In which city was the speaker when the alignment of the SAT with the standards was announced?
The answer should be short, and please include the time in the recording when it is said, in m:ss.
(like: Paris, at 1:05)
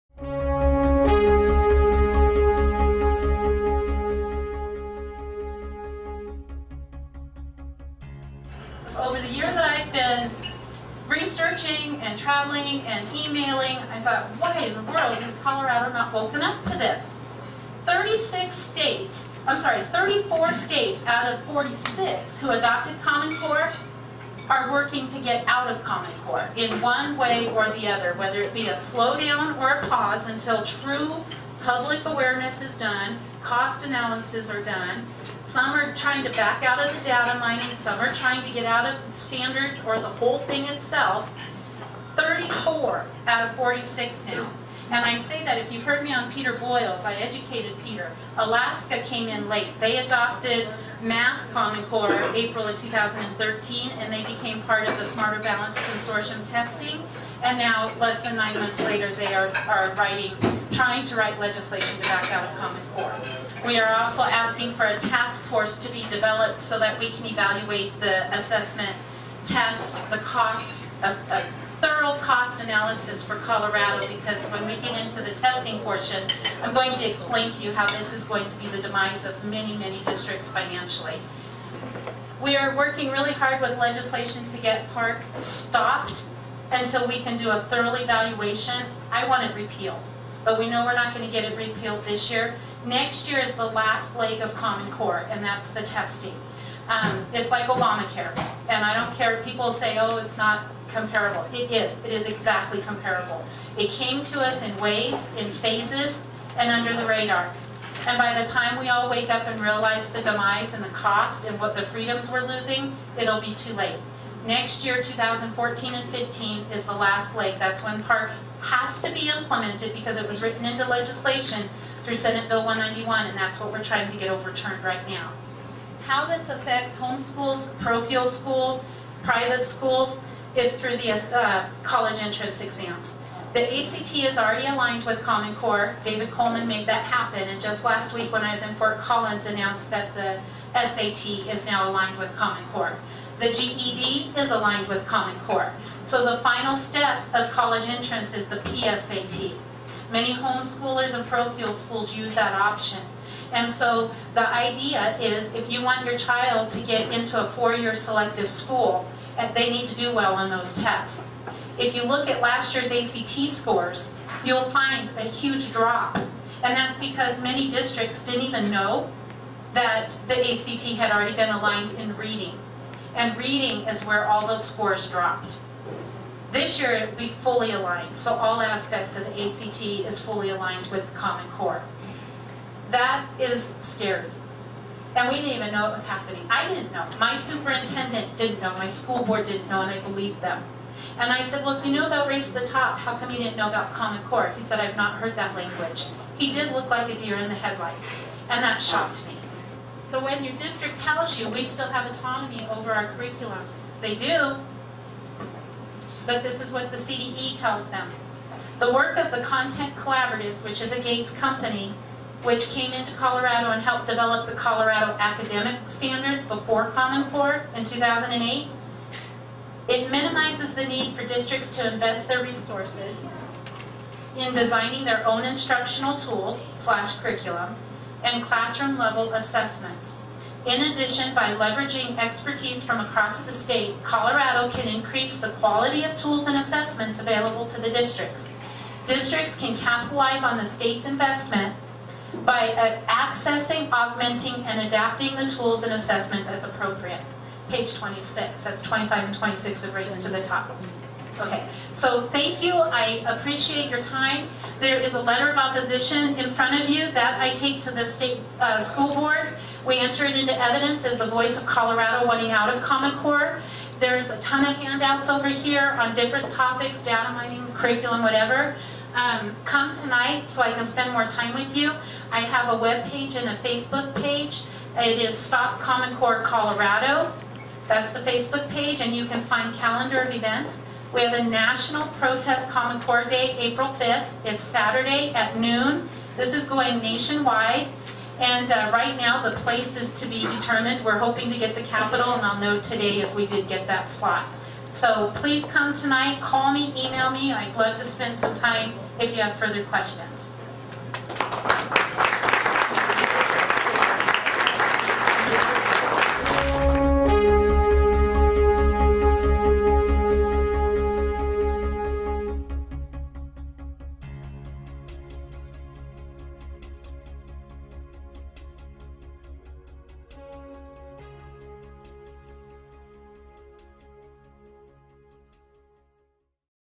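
Fort Collins, at 2:18.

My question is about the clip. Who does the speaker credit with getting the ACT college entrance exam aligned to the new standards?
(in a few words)
David Coleman.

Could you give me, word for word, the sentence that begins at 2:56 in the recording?
This year it will be fully aligned, so all aspects of the ACT is fully aligned with Common Core.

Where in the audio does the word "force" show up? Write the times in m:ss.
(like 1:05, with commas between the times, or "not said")
1:05.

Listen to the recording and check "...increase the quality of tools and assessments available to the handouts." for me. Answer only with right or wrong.
wrong.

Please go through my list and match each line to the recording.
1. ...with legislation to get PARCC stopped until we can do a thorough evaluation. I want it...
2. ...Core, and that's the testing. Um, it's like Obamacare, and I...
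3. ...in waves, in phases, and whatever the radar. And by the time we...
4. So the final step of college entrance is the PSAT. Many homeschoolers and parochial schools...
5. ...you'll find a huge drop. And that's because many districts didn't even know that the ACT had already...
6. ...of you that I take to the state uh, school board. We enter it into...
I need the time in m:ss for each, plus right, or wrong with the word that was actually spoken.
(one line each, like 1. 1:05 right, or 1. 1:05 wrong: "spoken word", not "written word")
1. 1:23 right
2. 1:34 right
3. 1:44 wrong: "under", not "whatever"
4. 2:26 right
5. 2:44 right
6. 4:16 right.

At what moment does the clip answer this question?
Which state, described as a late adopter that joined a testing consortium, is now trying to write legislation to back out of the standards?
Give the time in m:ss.
0:48.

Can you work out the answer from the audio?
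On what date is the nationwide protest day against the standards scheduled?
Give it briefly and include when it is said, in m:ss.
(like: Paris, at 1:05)
April 5th, at 4:43.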